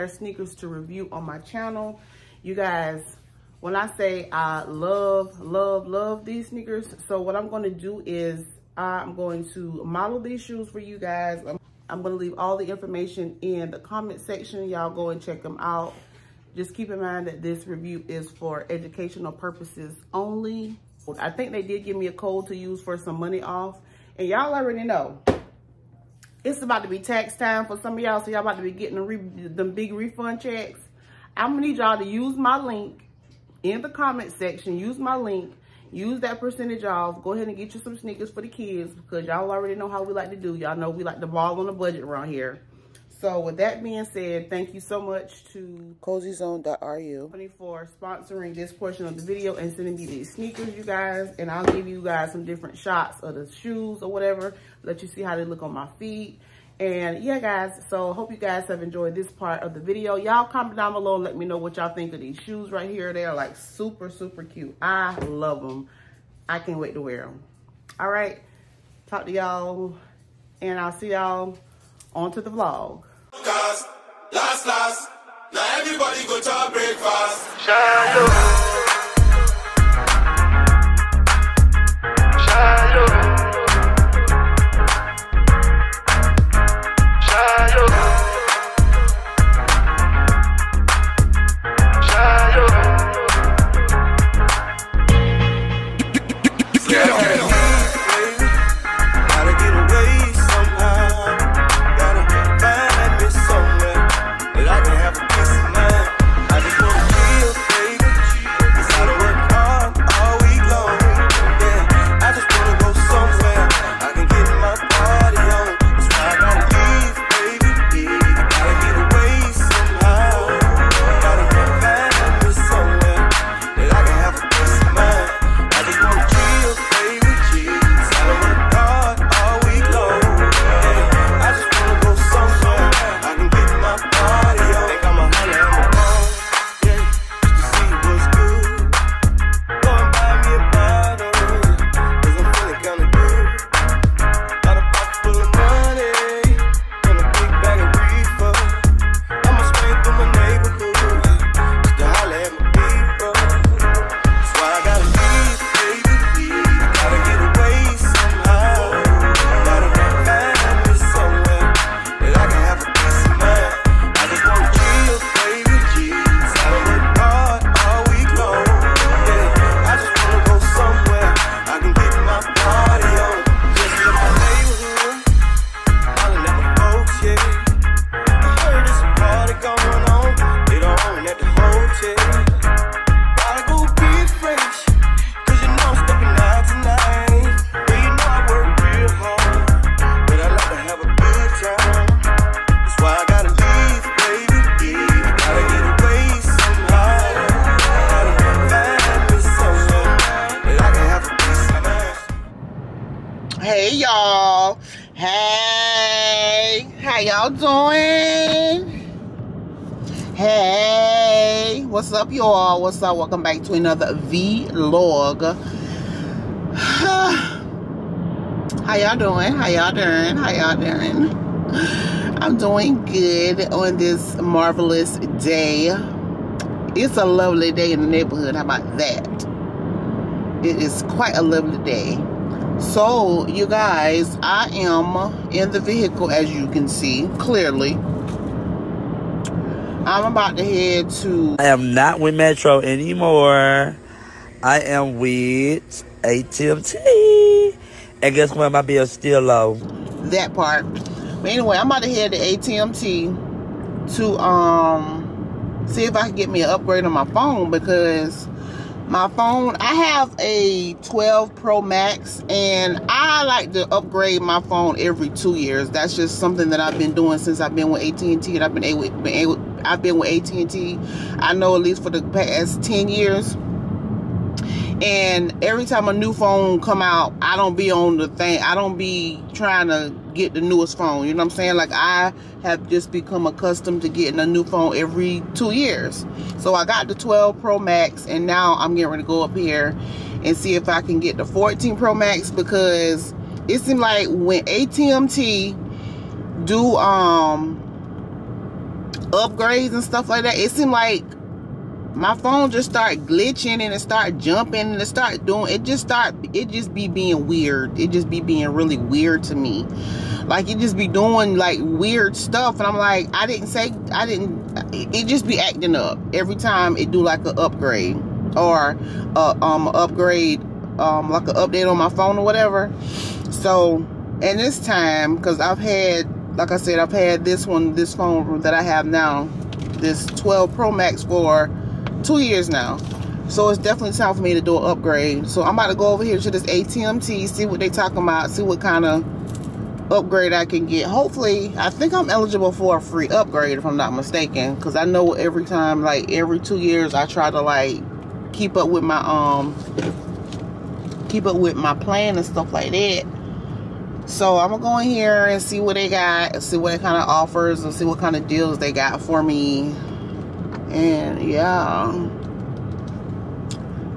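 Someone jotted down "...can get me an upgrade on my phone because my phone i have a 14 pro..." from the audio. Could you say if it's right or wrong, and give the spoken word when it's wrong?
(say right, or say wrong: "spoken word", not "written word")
wrong: "12", not "14".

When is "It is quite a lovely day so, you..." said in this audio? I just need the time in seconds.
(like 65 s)
230 s.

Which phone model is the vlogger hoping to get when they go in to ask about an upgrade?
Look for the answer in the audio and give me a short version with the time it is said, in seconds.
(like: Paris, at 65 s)
14 Pro Max, at 291 s.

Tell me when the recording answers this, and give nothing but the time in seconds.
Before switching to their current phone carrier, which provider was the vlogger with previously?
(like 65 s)
242 s.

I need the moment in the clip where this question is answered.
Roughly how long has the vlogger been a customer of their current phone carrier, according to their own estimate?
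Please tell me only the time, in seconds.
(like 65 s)
272 s.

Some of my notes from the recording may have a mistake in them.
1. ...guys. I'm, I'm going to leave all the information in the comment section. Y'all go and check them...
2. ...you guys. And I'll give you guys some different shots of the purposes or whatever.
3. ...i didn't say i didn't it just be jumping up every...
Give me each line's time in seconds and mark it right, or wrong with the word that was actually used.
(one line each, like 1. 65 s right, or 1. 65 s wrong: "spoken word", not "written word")
1. 10 s right
2. 50 s wrong: "shoes", not "purposes"
3. 313 s wrong: "acting", not "jumping".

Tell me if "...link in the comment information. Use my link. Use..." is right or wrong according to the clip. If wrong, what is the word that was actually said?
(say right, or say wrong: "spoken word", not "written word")
wrong: "section", not "information".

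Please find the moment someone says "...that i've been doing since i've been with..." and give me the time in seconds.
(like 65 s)
266 s.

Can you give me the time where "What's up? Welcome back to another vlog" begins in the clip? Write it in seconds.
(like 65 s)
212 s.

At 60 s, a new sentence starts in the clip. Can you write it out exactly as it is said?
Y'all comment down below and let me know what y'all think of these shoes right here.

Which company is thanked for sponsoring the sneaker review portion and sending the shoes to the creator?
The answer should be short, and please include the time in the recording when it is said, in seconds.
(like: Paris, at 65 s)
CosyZone.ru, at 46 s.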